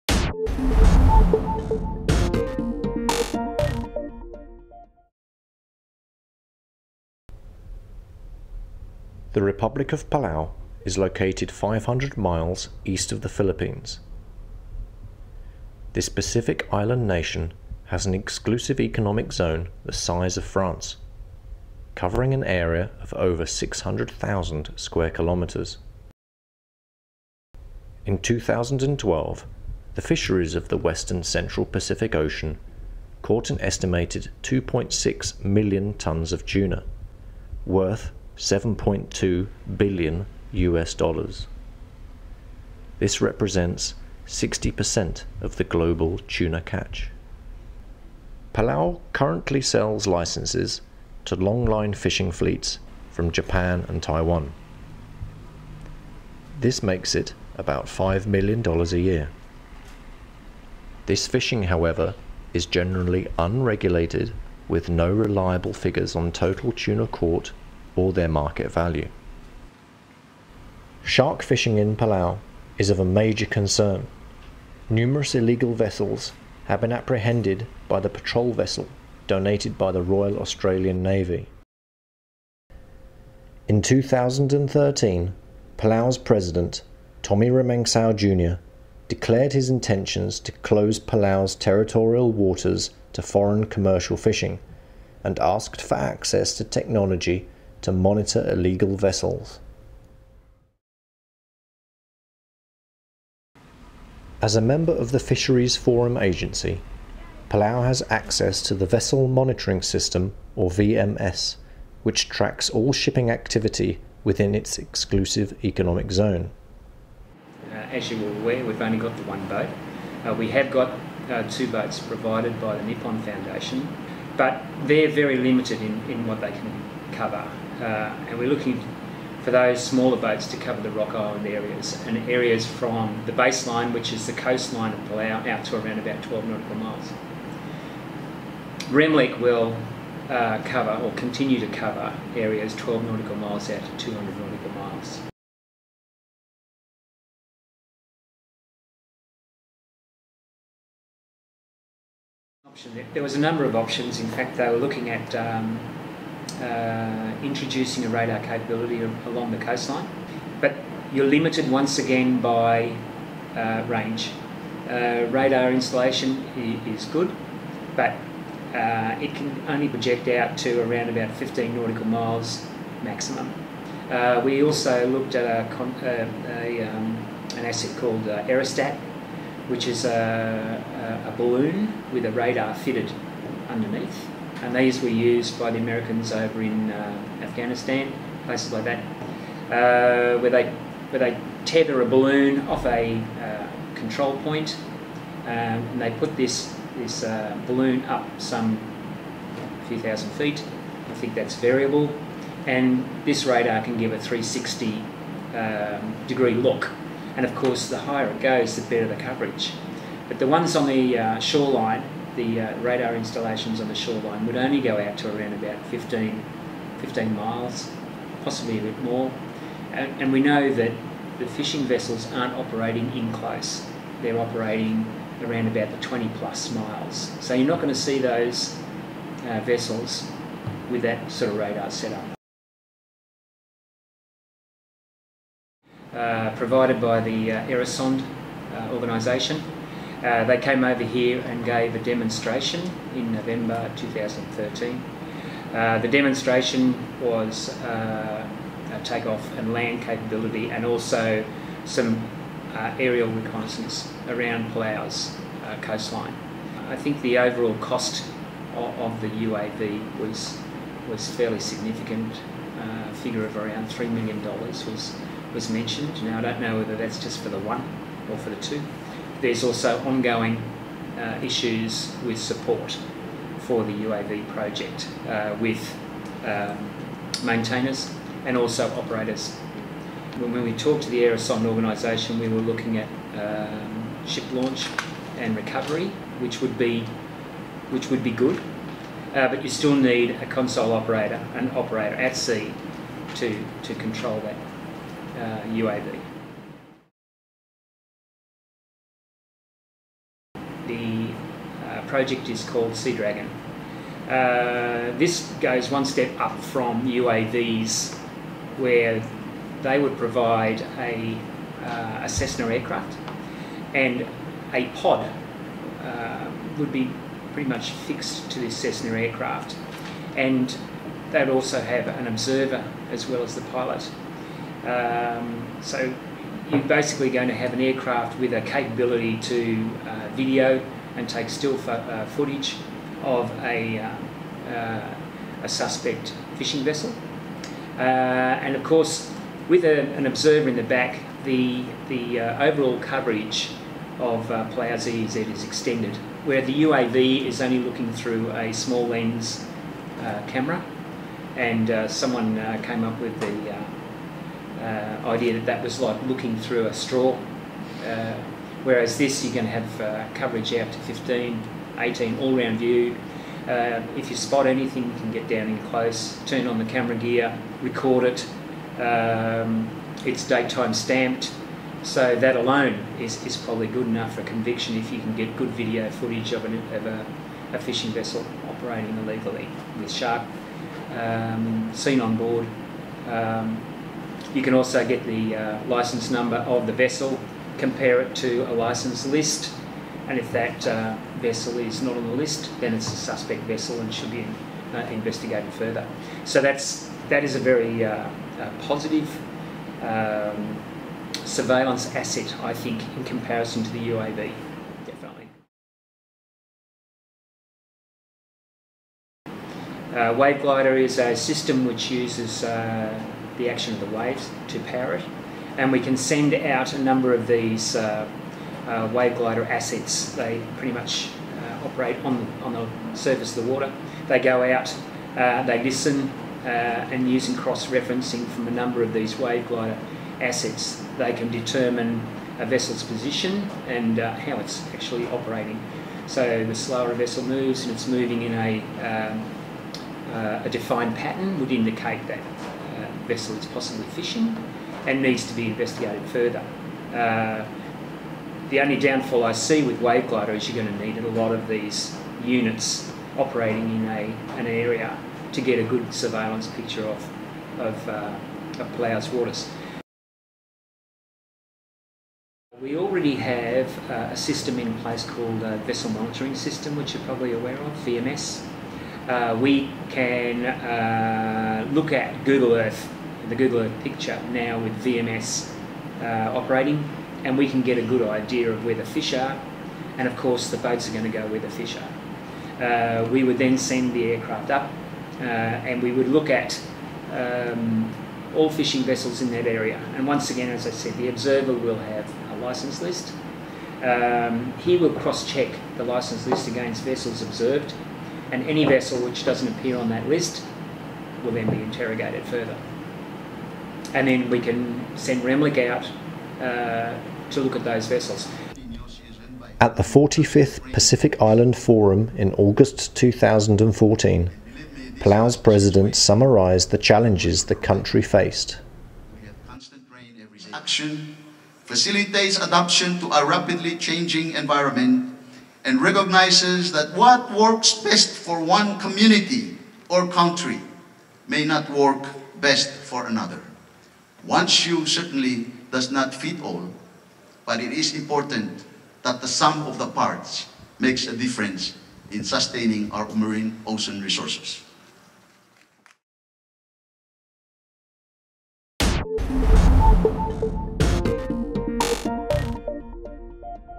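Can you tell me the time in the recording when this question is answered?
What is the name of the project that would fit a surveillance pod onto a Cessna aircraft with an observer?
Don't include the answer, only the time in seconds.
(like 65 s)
302 s.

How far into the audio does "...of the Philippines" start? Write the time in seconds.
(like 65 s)
13 s.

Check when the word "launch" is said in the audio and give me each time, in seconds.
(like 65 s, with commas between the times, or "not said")
284 s.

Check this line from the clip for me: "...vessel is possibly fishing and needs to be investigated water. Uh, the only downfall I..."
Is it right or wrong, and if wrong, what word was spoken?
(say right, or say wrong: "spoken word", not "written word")
wrong: "further", not "water".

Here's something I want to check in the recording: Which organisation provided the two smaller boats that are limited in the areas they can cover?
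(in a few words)
Nippon Foundation.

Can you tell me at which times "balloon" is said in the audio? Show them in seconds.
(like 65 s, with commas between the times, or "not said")
181 s, 192 s, 197 s.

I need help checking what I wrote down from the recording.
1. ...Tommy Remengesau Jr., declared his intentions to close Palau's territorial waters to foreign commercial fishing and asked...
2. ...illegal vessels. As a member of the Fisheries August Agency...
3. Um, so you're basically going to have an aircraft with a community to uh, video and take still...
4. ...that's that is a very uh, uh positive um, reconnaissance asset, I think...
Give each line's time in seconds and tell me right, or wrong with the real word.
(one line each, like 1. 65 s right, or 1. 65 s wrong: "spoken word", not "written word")
1. 87 s right
2. 98 s wrong: "Forum", not "August"
3. 324 s wrong: "capability", not "community"
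4. 396 s wrong: "surveillance", not "reconnaissance".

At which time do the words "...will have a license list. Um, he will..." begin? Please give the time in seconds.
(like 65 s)
491 s.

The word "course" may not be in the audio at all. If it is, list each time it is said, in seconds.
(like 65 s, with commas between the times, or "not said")
207 s, 338 s, 480 s.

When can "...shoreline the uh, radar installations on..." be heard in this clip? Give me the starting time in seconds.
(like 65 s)
211 s.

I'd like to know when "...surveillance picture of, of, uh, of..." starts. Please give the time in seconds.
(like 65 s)
456 s.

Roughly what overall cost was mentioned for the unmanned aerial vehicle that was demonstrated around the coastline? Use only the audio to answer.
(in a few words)
$3 million.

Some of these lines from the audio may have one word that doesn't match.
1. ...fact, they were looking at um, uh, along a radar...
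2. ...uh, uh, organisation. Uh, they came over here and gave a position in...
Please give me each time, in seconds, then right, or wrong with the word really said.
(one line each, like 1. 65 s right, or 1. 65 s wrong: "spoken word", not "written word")
1. 154 s wrong: "introducing", not "along"
2. 237 s wrong: "demonstration", not "position".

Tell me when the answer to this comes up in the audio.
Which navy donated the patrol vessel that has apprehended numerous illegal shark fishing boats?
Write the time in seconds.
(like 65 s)
80 s.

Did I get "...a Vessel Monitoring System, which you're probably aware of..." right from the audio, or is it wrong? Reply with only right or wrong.
right.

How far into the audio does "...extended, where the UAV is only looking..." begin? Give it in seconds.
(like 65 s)
345 s.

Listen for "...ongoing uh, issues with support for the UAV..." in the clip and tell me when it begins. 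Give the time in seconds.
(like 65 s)
270 s.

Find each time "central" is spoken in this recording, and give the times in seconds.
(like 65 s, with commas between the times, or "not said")
31 s.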